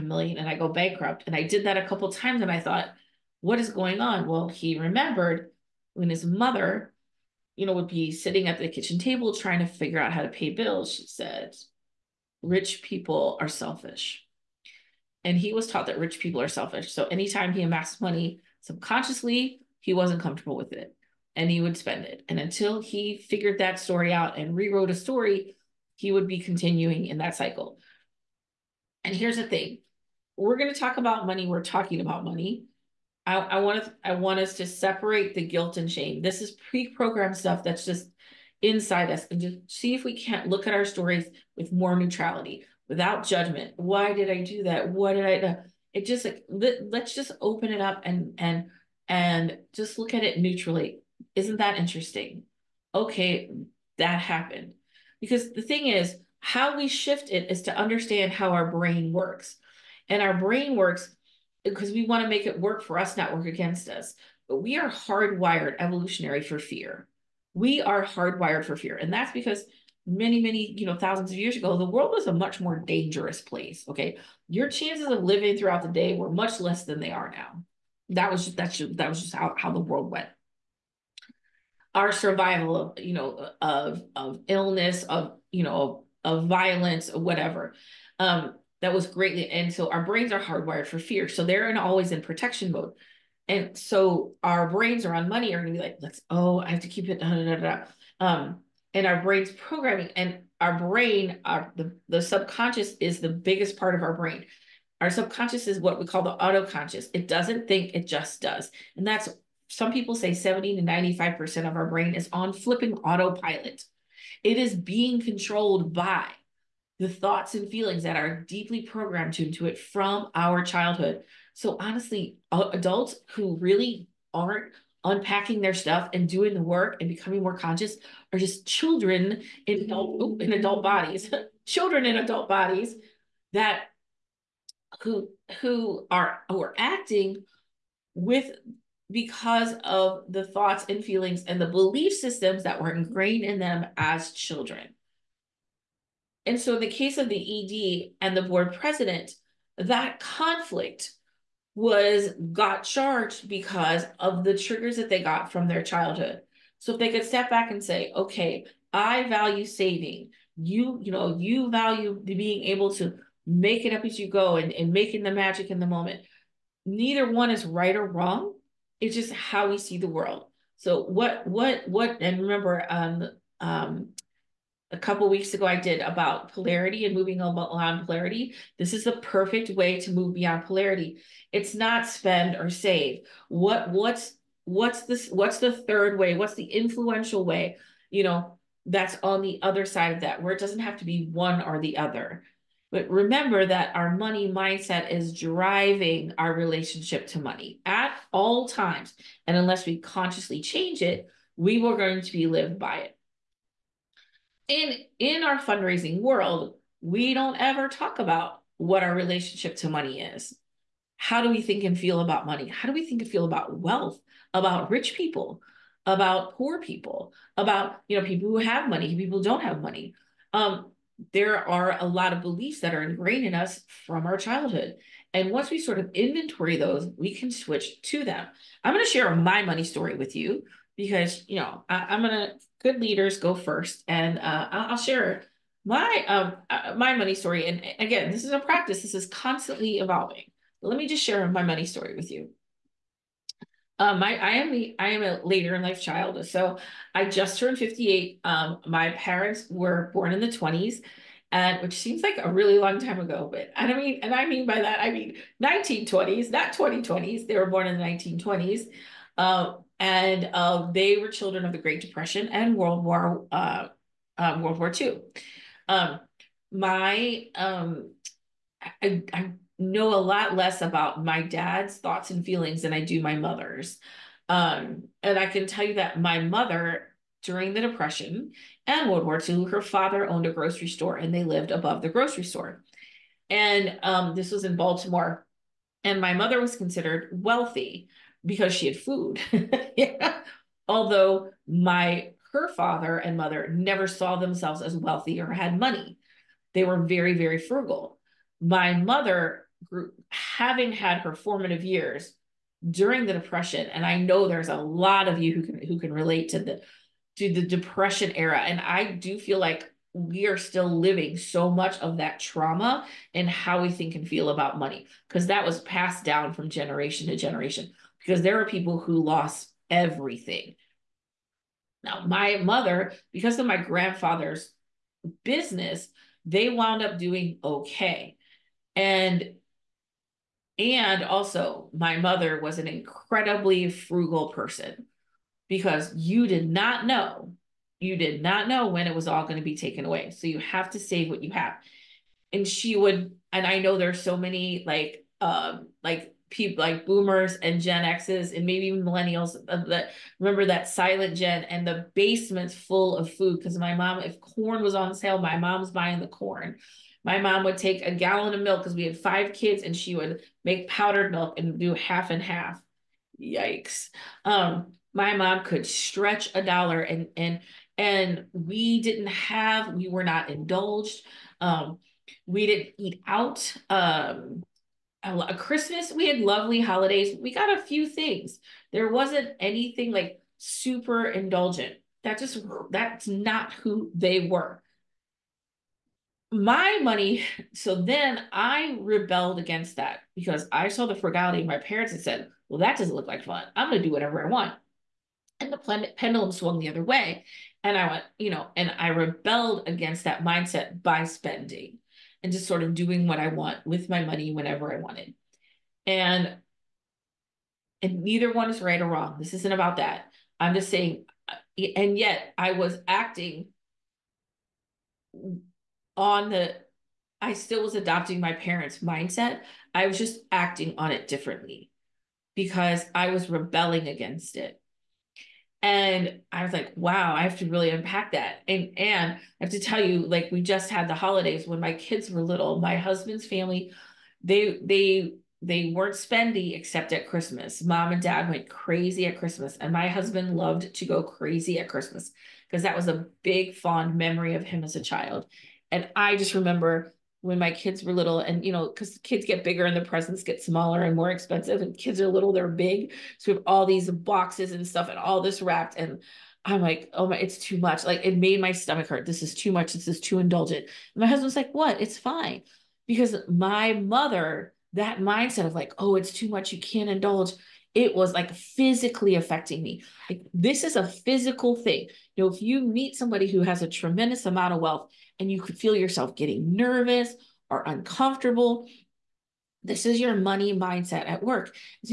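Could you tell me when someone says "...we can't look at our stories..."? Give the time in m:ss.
0:40.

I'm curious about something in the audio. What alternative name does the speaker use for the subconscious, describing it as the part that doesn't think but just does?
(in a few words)
autoconscious.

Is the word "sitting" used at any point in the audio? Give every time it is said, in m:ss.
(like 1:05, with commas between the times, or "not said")
0:08.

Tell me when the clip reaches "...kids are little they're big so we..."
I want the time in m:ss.
7:31.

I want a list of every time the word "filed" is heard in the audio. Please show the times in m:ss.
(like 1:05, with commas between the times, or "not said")
not said.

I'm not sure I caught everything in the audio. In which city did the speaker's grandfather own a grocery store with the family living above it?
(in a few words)
Baltimore.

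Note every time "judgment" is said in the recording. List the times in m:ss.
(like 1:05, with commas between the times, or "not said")
0:43.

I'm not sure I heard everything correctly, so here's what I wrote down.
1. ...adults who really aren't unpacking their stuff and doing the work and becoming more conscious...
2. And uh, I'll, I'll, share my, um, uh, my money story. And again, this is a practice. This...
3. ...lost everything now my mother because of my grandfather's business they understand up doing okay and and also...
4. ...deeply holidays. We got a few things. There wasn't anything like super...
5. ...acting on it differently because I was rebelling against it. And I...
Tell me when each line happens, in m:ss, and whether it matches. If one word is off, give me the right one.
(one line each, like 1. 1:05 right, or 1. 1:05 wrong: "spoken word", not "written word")
1. 2:02 right
2. 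3:54 right
3. 5:19 wrong: "wound", not "understand"
4. 6:16 wrong: "lovely", not "deeply"
5. 7:00 right.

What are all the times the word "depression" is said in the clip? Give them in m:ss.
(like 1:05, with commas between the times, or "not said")
4:21, 4:37, 5:03, 5:07.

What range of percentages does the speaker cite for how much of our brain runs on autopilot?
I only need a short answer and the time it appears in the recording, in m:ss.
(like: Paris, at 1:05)
70 to 95%, at 1:50.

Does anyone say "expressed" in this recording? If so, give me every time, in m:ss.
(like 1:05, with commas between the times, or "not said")
not said.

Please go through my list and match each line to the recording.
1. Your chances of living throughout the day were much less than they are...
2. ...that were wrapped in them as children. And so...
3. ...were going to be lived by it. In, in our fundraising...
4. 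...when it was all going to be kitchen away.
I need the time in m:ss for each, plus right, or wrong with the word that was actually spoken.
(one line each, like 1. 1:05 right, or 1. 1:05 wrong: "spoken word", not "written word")
1. 1:14 right
2. 2:22 wrong: "ingrained", not "wrapped"
3. 3:21 right
4. 5:38 wrong: "taken", not "kitchen".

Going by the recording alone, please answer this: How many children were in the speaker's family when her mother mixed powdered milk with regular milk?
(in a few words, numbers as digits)
5.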